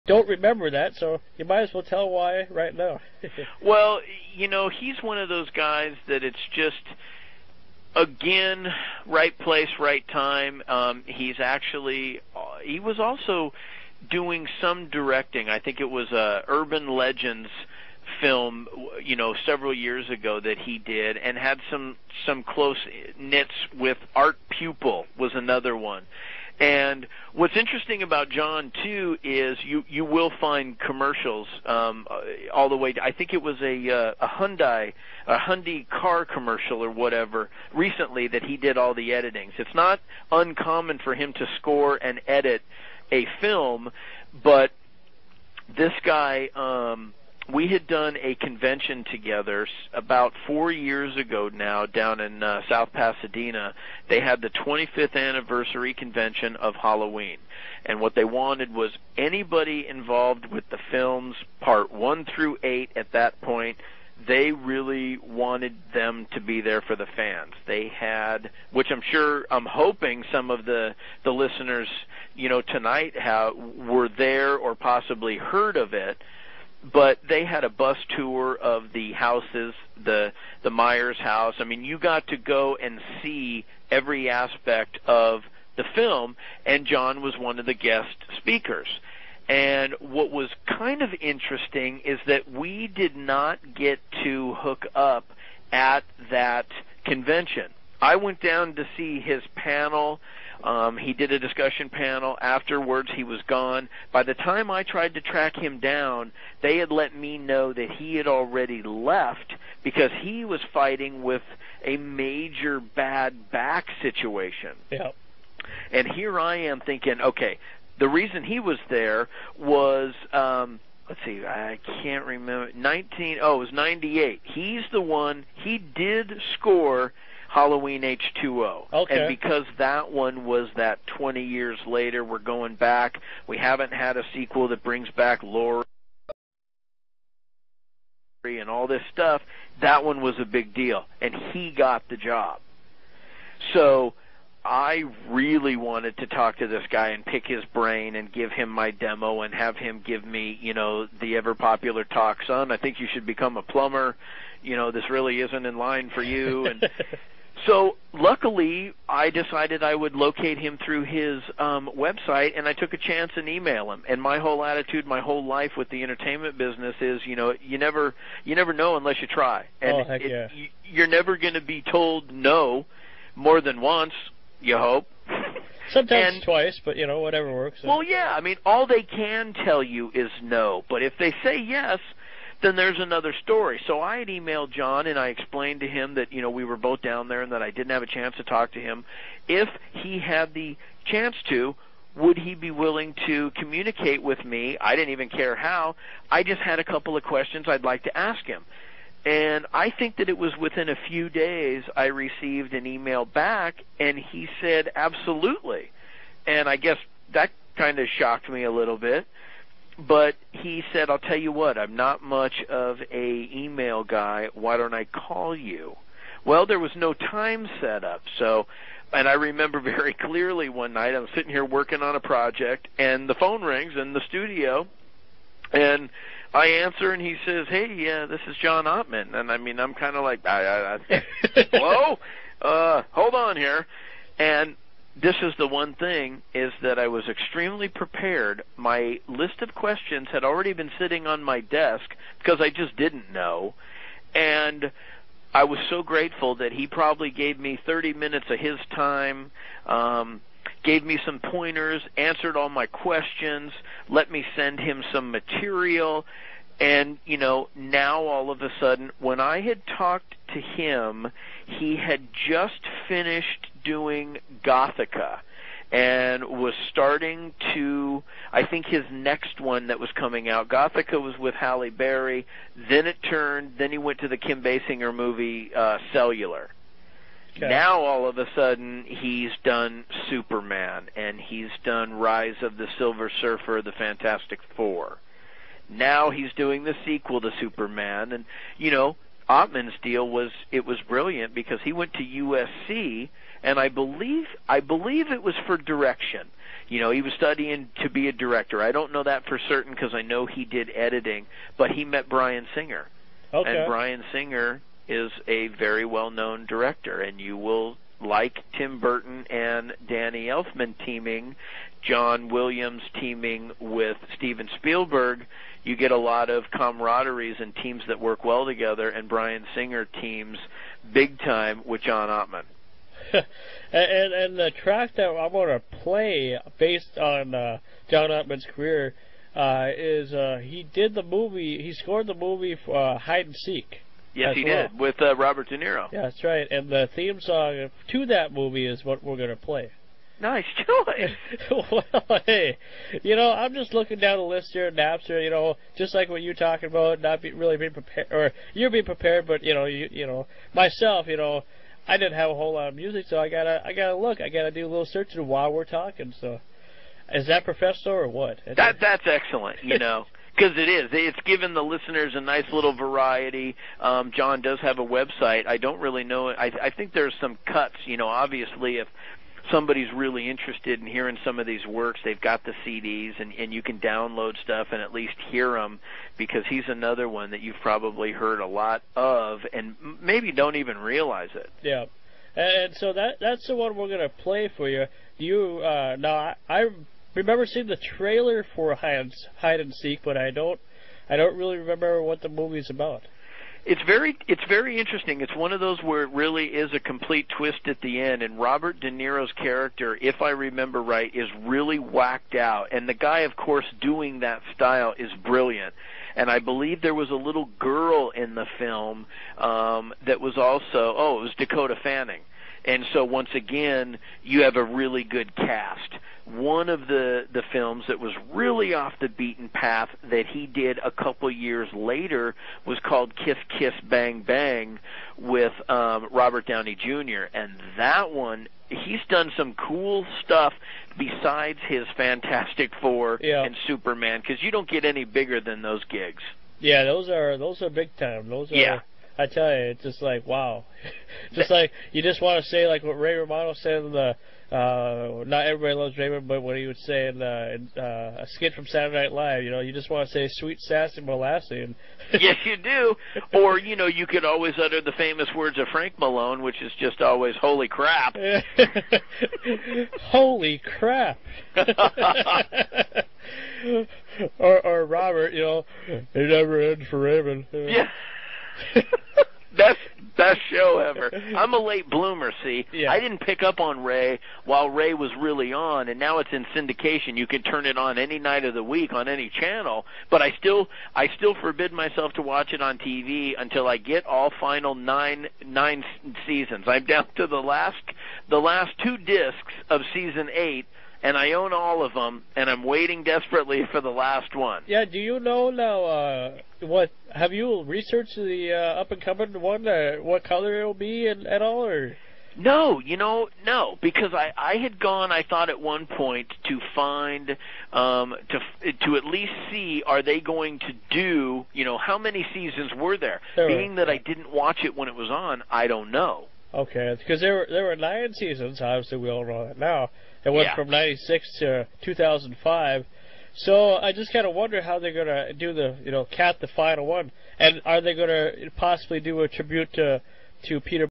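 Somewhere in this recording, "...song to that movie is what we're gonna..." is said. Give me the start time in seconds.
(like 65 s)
337 s.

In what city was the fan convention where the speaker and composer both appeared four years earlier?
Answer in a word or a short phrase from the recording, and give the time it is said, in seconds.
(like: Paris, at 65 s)
South Pasadena, at 52 s.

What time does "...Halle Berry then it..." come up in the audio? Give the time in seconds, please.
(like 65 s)
271 s.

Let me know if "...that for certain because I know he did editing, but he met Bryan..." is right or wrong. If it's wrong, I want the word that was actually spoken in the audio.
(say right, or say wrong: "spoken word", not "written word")
right.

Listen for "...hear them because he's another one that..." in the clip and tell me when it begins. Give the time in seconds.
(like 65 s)
375 s.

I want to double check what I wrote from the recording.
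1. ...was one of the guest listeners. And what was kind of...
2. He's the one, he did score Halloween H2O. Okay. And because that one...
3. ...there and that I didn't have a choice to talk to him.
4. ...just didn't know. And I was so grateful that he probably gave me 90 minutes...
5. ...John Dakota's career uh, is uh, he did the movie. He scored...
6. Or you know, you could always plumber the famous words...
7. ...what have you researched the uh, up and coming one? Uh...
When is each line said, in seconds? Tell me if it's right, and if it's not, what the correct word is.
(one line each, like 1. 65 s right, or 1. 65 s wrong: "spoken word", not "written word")
1. 87 s wrong: "speakers", not "listeners"
2. 124 s right
3. 187 s wrong: "chance", not "choice"
4. 242 s wrong: "30", not "90"
5. 328 s wrong: "Ottman", not "Dakota"
6. 453 s wrong: "utter", not "plumber"
7. 496 s right.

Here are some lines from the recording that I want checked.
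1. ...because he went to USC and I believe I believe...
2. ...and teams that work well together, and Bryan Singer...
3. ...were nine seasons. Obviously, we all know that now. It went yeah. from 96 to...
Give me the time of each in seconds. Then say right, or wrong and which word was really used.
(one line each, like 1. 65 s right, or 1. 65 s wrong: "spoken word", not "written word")
1. 291 s right
2. 317 s right
3. 517 s right.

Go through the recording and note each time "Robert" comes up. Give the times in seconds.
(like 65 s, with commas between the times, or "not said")
335 s, 398 s, 426 s, 465 s.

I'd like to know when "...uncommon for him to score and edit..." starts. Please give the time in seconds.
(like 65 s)
40 s.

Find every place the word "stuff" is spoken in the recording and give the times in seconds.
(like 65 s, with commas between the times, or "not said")
139 s, 374 s, 430 s.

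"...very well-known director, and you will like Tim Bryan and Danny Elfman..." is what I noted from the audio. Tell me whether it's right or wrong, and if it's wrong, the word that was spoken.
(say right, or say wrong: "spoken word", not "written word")
wrong: "Burton", not "Bryan".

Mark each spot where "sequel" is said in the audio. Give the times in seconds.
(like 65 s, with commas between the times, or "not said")
134 s, 287 s.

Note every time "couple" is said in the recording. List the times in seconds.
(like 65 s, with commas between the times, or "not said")
196 s, 421 s.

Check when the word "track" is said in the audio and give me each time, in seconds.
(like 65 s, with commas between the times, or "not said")
105 s, 324 s.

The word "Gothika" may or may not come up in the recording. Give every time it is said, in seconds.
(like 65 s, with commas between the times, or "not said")
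264 s, 270 s.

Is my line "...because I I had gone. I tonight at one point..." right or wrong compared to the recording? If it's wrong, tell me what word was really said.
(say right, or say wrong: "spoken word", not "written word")
wrong: "thought", not "tonight".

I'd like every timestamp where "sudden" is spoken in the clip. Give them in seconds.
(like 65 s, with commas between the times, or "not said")
258 s, 278 s.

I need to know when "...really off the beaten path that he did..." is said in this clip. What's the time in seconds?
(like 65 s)
418 s.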